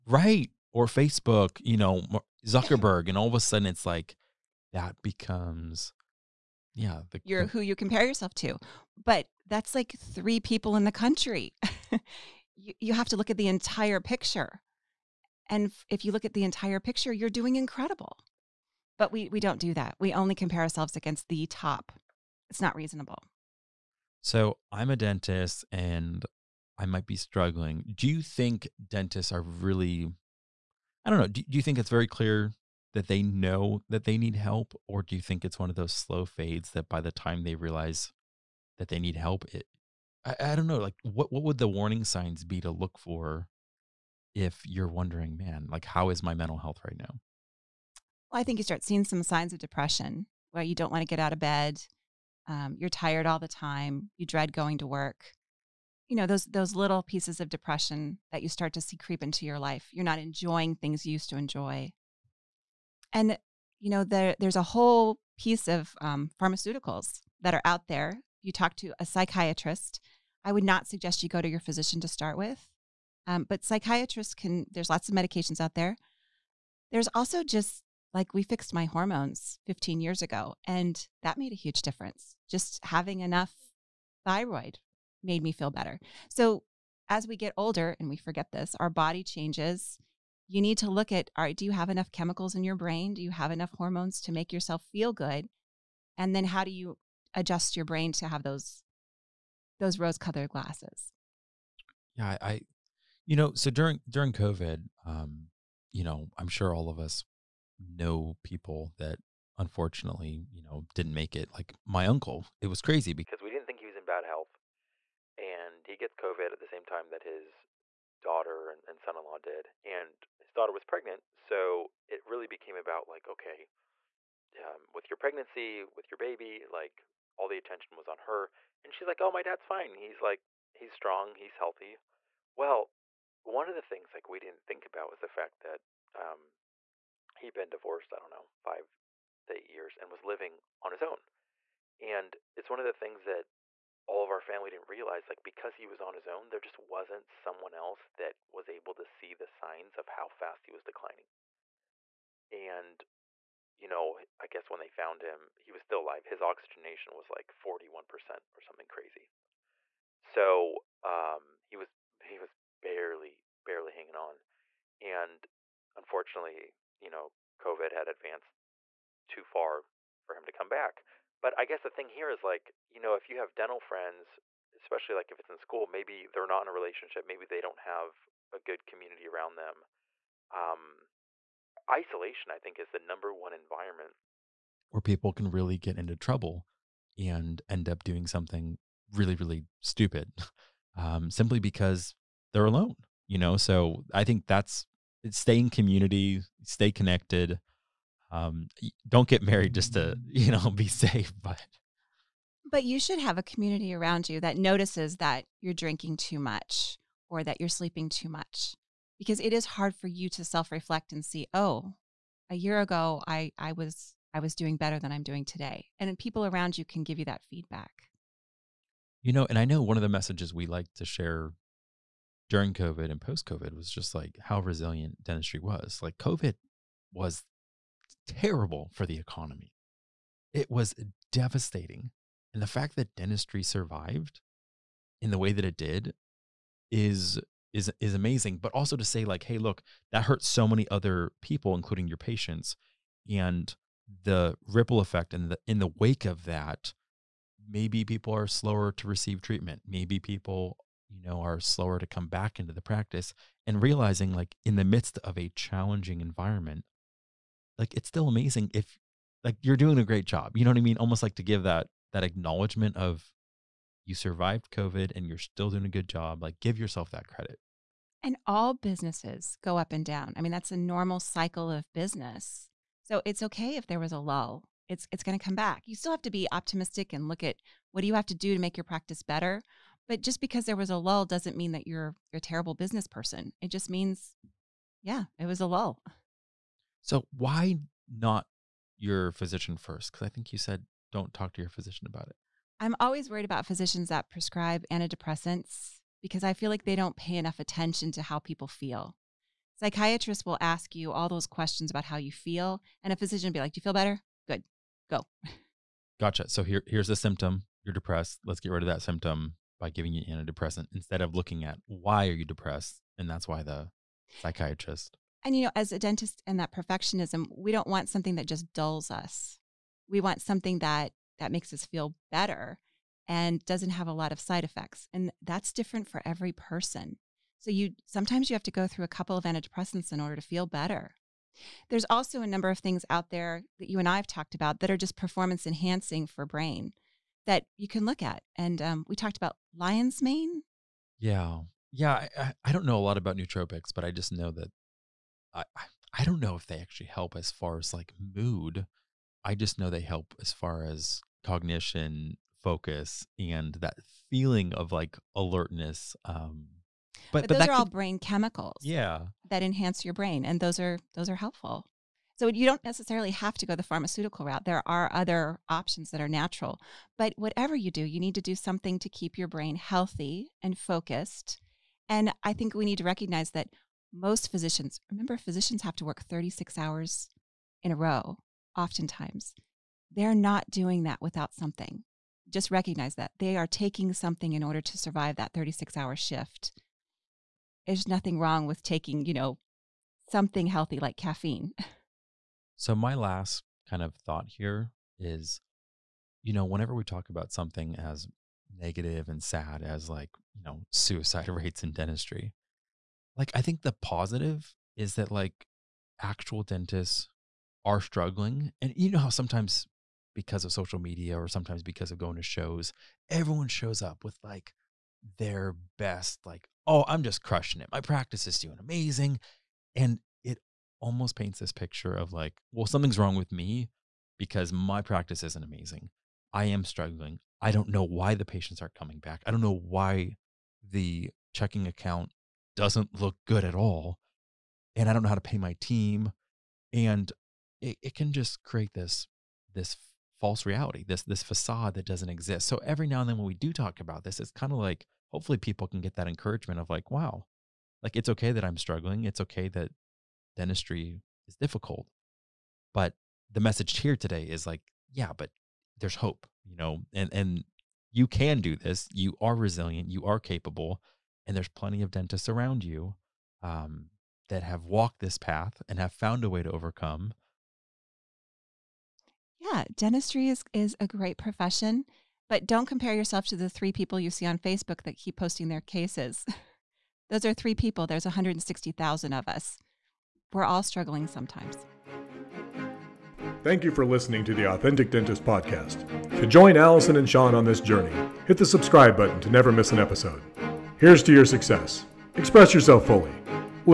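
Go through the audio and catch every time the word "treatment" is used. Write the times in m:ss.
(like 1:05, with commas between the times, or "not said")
4:09.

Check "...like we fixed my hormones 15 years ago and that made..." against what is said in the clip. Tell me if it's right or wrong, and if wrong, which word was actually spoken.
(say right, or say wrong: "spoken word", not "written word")
right.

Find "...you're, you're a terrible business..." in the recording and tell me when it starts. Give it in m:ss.
4:41.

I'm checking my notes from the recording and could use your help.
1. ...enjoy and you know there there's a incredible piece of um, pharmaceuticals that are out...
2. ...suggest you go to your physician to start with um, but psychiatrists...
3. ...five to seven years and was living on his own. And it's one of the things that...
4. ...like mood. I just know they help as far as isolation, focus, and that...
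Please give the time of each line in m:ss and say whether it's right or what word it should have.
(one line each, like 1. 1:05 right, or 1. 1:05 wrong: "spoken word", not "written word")
1. 1:01 wrong: "whole", not "incredible"
2. 1:10 right
3. 2:18 wrong: "eight", not "seven"
4. 5:47 wrong: "cognition", not "isolation".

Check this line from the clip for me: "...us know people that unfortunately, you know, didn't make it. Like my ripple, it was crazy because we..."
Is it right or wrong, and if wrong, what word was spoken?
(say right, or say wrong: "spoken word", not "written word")
wrong: "uncle", not "ripple".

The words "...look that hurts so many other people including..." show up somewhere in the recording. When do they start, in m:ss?
3:59.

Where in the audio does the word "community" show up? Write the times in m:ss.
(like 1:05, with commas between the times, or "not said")
2:58, 3:15, 3:23.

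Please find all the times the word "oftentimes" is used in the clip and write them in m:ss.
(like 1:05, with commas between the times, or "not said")
6:18.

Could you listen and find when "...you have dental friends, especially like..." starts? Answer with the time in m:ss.
2:53.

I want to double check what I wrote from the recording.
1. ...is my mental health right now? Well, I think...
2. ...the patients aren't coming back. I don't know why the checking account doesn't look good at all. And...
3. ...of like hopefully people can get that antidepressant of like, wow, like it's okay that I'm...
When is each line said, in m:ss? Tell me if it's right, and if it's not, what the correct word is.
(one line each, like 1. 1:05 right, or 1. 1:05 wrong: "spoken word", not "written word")
1. 0:46 right
2. 7:08 right
3. 7:24 wrong: "encouragement", not "antidepressant".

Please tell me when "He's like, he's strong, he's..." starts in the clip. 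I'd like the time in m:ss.
2:09.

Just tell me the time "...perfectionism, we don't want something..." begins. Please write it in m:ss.
5:16.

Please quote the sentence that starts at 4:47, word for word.
So why not your physician first?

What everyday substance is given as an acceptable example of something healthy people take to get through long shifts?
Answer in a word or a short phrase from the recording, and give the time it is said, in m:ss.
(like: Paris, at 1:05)
caffeine, at 6:31.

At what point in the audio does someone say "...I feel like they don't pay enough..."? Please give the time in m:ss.
4:56.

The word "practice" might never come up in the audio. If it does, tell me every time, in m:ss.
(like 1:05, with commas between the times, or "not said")
4:12, 4:38, 6:57, 7:05.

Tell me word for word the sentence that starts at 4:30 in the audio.
I mean, that's a normal cycle of business.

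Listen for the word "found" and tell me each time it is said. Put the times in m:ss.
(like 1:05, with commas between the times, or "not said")
2:34, 7:46.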